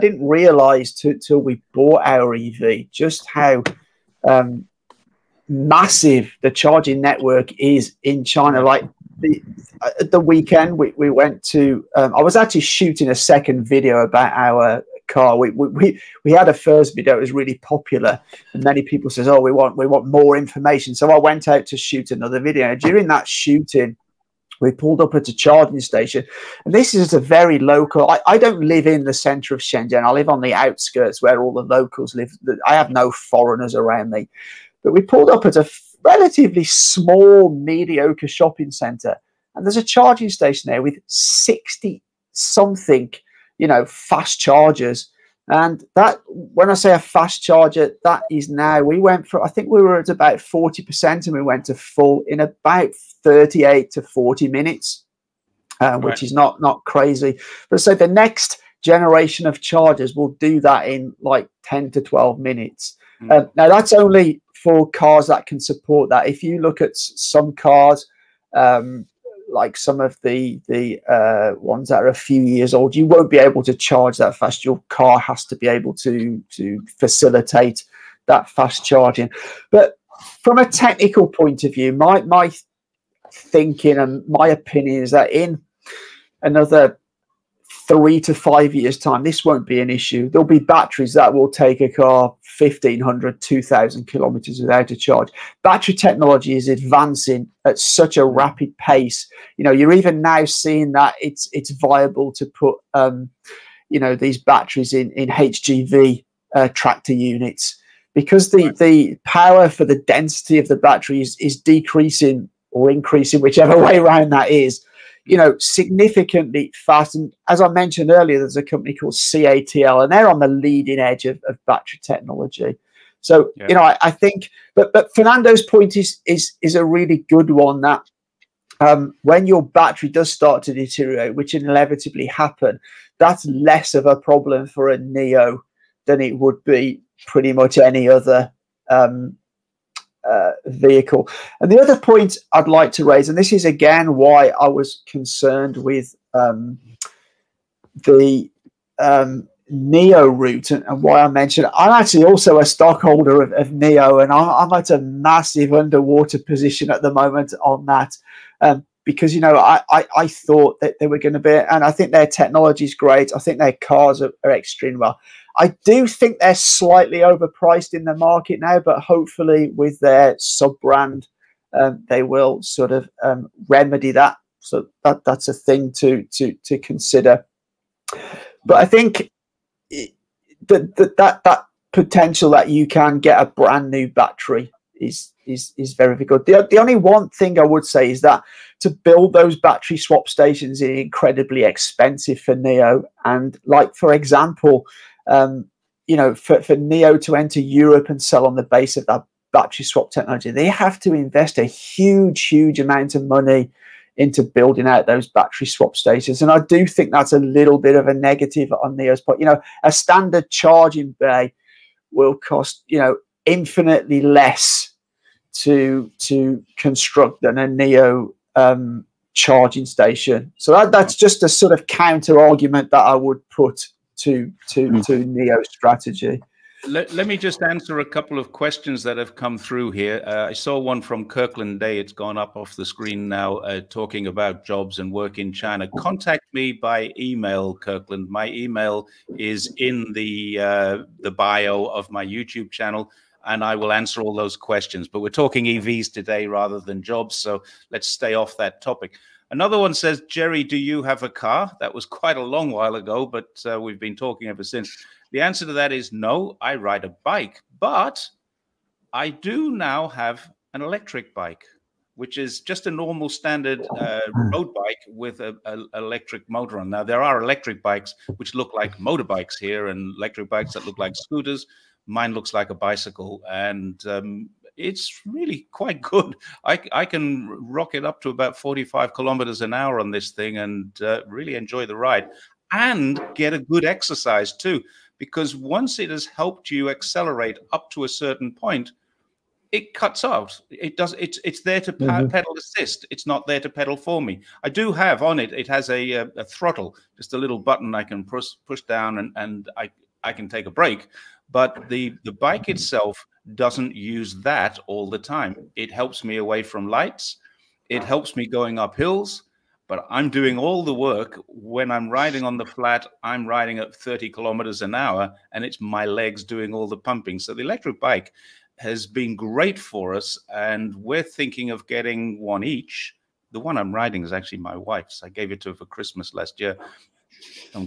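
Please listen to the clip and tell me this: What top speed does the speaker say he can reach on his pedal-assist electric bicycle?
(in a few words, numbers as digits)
45 km/h.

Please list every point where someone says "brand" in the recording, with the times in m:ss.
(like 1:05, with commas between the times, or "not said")
2:50, 3:03.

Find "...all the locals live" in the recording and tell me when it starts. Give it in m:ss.
0:31.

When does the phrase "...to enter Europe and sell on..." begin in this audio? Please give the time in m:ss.
3:17.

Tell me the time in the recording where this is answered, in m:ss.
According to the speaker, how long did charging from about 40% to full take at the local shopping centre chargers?
0:53.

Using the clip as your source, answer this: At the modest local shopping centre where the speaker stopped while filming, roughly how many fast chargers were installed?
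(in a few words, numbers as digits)
60.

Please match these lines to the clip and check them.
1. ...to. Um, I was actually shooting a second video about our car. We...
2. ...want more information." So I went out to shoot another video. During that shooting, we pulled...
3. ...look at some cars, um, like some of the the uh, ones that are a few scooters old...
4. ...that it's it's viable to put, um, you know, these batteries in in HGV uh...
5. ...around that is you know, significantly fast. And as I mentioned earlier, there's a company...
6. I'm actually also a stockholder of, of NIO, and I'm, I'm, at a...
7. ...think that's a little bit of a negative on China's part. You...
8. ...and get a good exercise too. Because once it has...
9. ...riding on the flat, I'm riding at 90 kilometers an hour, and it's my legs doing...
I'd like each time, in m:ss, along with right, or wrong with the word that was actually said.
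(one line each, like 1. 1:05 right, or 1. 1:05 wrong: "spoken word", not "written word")
1. 0:11 right
2. 0:19 right
3. 1:06 wrong: "years", not "scooters"
4. 1:40 right
5. 1:53 right
6. 2:31 right
7. 3:26 wrong: "NIO", not "China"
8. 4:42 right
9. 5:12 wrong: "30", not "90".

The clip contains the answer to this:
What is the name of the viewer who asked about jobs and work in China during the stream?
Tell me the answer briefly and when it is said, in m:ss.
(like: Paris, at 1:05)
Kirkland Day, at 3:51.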